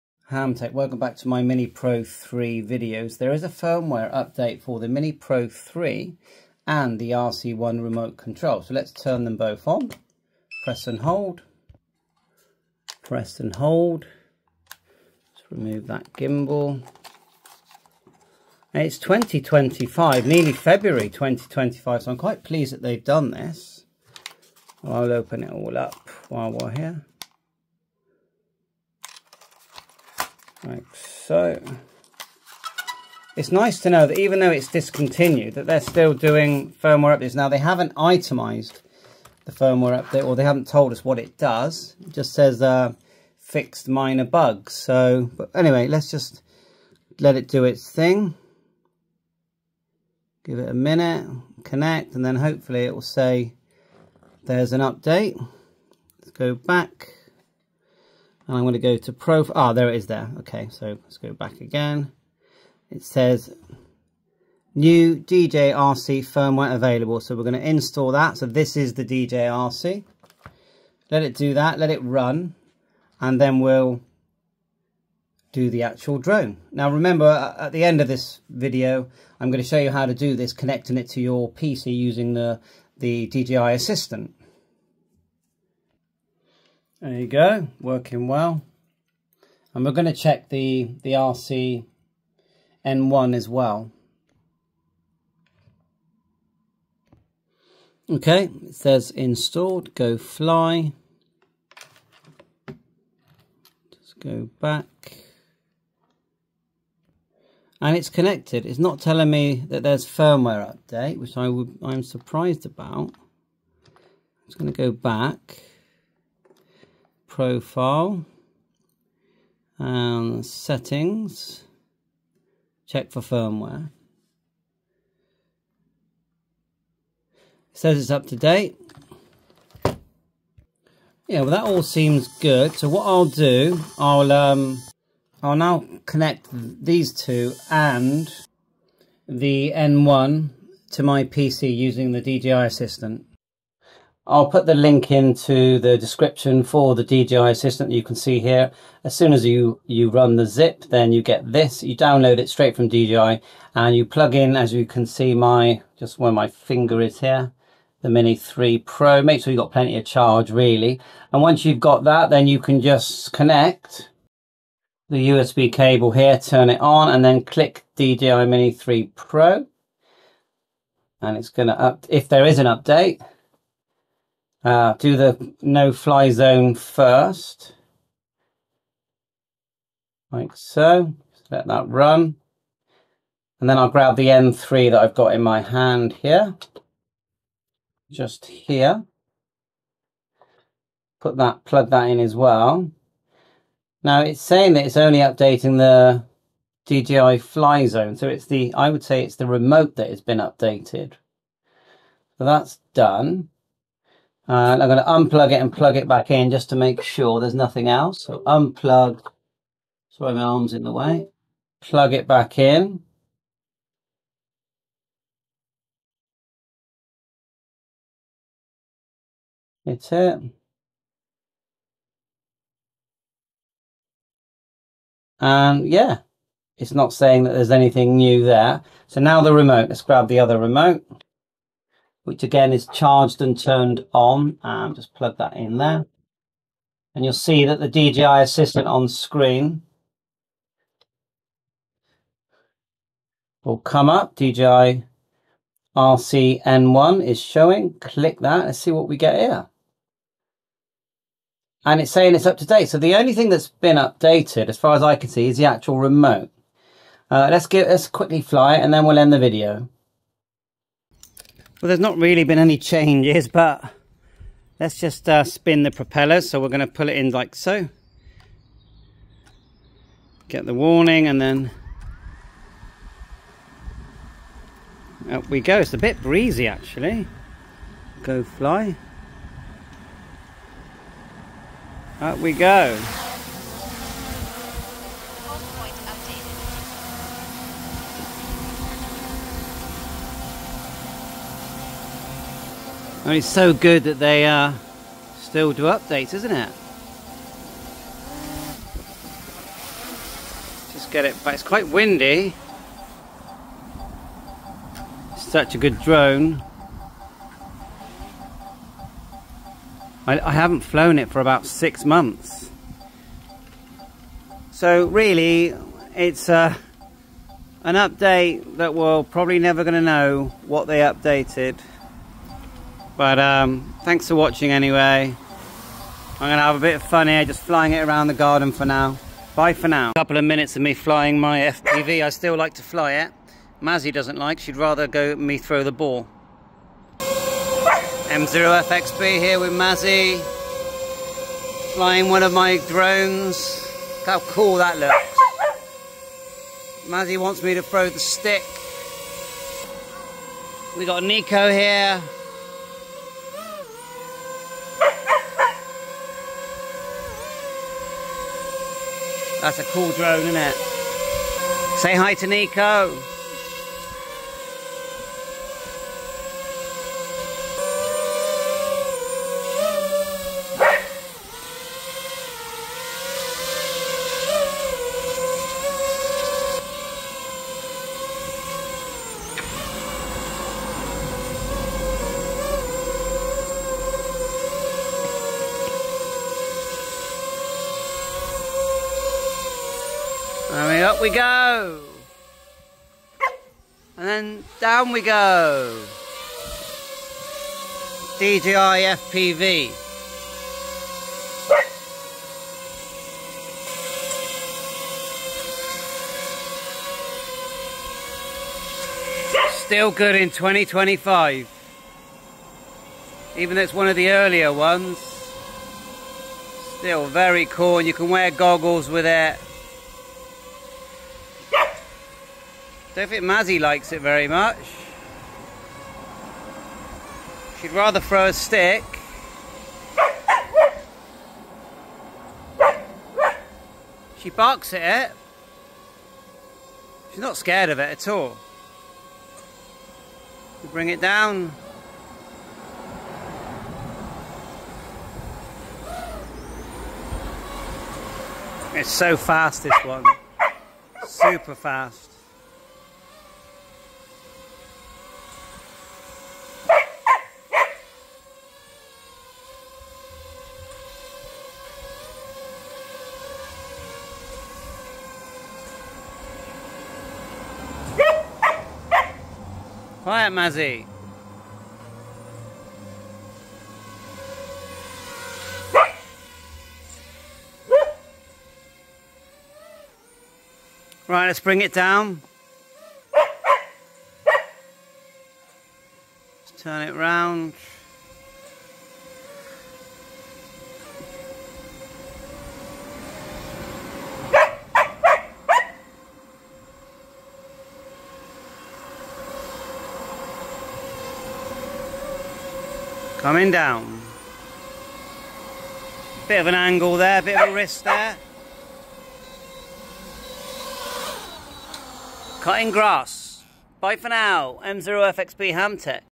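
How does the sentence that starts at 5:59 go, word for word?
That's a cool drone, isn't it?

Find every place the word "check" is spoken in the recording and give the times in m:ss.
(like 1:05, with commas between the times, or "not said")
1:30, 2:02.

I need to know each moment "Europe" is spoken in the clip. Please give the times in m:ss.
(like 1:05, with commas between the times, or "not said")
not said.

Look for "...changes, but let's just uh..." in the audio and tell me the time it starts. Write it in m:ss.
4:22.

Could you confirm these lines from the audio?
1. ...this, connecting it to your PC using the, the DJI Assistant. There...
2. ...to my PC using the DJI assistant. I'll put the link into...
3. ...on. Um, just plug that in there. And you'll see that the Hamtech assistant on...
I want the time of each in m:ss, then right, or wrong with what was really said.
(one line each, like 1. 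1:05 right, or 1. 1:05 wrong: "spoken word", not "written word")
1. 1:20 right
2. 2:20 right
3. 3:54 wrong: "DJI", not "Hamtech".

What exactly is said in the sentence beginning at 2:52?
if there is an update, uh, do the no fly zone first, like so.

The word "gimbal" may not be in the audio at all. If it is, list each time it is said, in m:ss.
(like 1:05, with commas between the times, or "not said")
0:16.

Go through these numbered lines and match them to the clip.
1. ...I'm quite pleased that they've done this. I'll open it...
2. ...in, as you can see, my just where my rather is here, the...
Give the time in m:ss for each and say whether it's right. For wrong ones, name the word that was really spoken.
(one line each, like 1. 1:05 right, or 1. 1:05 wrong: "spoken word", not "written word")
1. 0:22 right
2. 2:34 wrong: "finger", not "rather".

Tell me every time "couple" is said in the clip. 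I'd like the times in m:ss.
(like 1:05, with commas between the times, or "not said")
5:30.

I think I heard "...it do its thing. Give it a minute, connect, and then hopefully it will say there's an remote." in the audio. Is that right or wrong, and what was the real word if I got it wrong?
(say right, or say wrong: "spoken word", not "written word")
wrong: "update", not "remote".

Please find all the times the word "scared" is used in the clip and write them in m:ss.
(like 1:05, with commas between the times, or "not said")
7:17.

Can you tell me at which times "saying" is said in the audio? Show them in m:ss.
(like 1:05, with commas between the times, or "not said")
3:14, 3:47, 4:12.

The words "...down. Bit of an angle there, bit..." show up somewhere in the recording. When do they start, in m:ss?
8:23.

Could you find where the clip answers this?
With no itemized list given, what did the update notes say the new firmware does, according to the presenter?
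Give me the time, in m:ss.
0:43.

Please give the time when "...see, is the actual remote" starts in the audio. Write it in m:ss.
4:15.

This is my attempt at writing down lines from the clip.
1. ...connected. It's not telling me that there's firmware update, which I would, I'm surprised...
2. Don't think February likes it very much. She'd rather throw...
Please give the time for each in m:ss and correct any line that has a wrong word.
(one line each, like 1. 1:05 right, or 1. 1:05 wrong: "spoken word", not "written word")
1. 1:48 right
2. 7:03 wrong: "Mazzy", not "February".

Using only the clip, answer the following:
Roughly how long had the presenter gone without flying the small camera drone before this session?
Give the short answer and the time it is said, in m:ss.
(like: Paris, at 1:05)
about six months, at 5:11.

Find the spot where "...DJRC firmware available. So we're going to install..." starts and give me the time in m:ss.
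1:05.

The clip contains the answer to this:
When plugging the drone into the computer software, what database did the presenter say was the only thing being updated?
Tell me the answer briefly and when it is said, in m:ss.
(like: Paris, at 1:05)
DJI Fly Zone, at 3:16.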